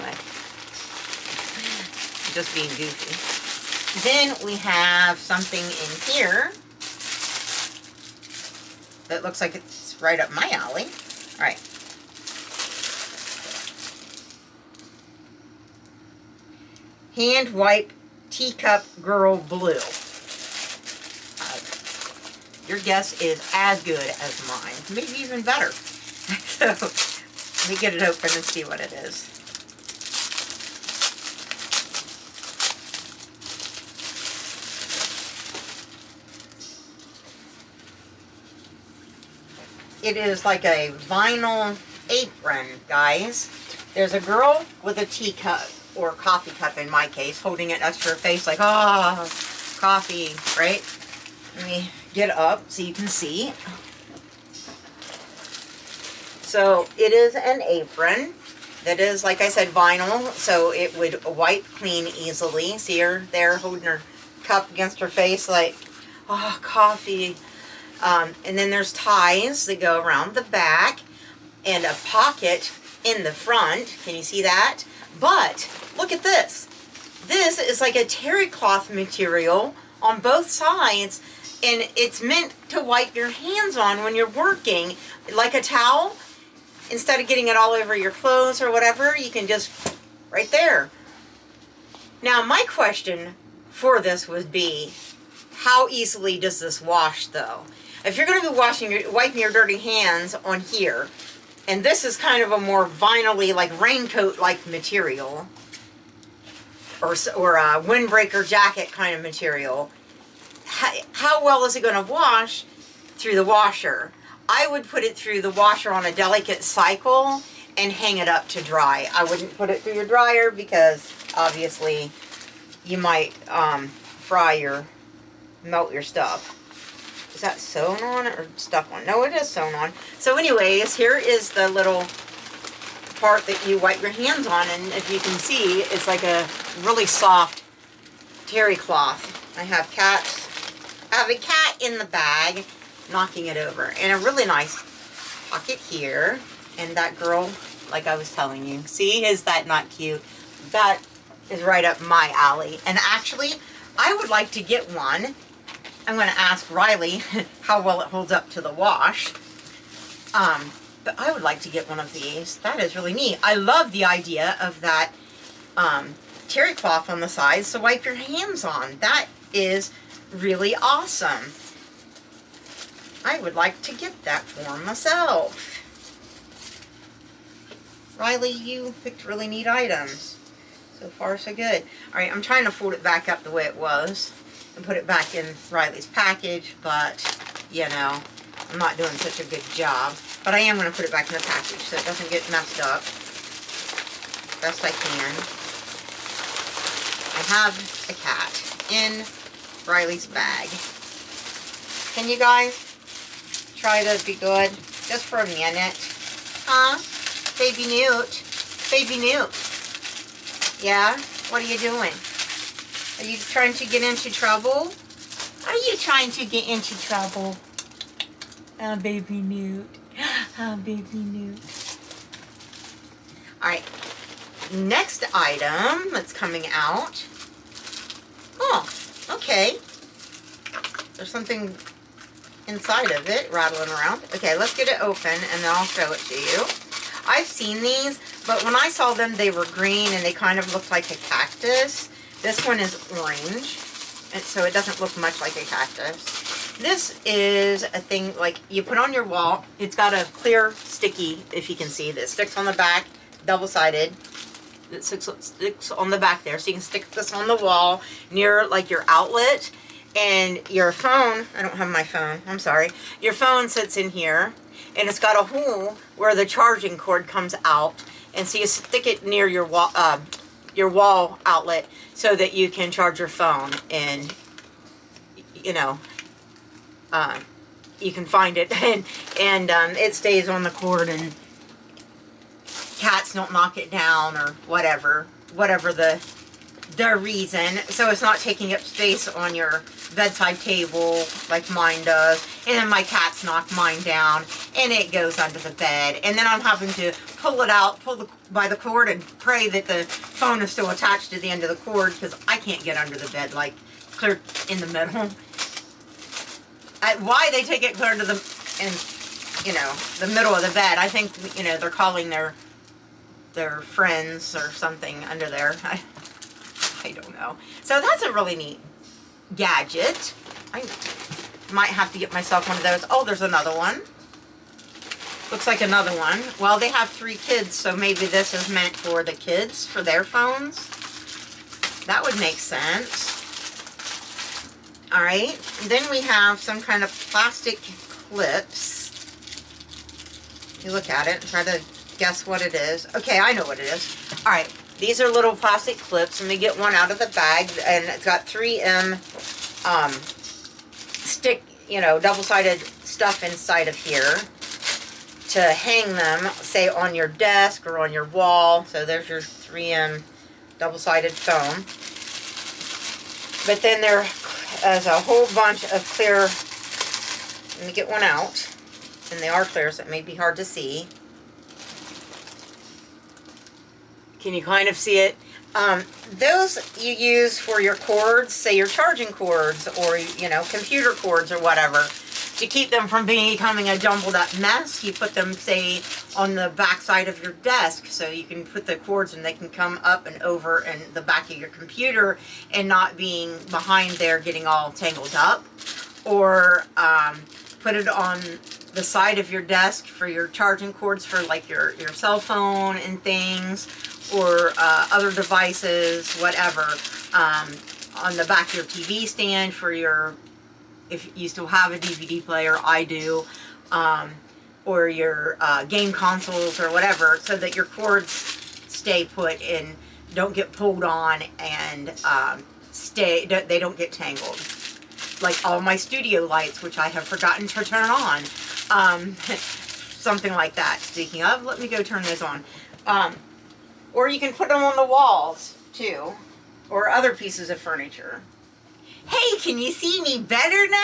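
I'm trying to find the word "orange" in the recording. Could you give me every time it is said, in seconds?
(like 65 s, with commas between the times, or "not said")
243 s.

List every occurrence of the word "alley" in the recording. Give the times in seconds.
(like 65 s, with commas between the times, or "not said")
10 s, 152 s.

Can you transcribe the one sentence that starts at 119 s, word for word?
I wouldn't put it through your dryer because obviously you might um, fry your, melt your stuff.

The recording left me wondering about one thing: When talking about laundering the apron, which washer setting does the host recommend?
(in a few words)
delicate cycle.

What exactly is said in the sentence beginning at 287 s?
So it's not taking up space on your bedside table like mine does.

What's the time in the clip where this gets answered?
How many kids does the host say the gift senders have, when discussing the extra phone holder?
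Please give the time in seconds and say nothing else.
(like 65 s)
327 s.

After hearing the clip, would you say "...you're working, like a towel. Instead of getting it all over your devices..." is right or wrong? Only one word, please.
wrong.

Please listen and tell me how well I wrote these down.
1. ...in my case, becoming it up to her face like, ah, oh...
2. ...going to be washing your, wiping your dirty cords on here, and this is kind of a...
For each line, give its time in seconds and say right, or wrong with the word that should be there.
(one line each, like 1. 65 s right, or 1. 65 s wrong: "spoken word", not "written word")
1. 46 s wrong: "holding", not "becoming"
2. 98 s wrong: "hands", not "cords".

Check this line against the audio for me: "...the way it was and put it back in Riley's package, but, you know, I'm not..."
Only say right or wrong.
right.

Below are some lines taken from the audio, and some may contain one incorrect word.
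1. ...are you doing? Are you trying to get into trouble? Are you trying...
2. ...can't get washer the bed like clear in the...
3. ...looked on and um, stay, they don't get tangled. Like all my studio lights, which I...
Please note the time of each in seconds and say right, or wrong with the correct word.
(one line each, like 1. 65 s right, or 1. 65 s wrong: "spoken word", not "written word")
1. 211 s right
2. 302 s wrong: "under", not "washer"
3. 420 s wrong: "pulled", not "looked".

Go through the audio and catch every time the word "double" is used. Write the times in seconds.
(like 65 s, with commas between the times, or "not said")
253 s, 352 s, 360 s.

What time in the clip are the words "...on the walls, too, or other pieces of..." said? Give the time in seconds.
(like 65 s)
434 s.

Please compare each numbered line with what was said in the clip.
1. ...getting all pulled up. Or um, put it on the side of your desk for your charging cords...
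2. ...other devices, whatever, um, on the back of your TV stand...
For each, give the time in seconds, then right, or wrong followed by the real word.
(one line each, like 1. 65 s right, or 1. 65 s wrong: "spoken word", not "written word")
1. 394 s wrong: "tangled", not "pulled"
2. 405 s right.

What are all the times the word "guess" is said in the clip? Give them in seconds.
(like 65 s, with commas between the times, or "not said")
22 s, 342 s.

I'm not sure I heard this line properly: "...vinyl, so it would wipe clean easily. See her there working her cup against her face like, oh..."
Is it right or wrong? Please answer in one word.
wrong.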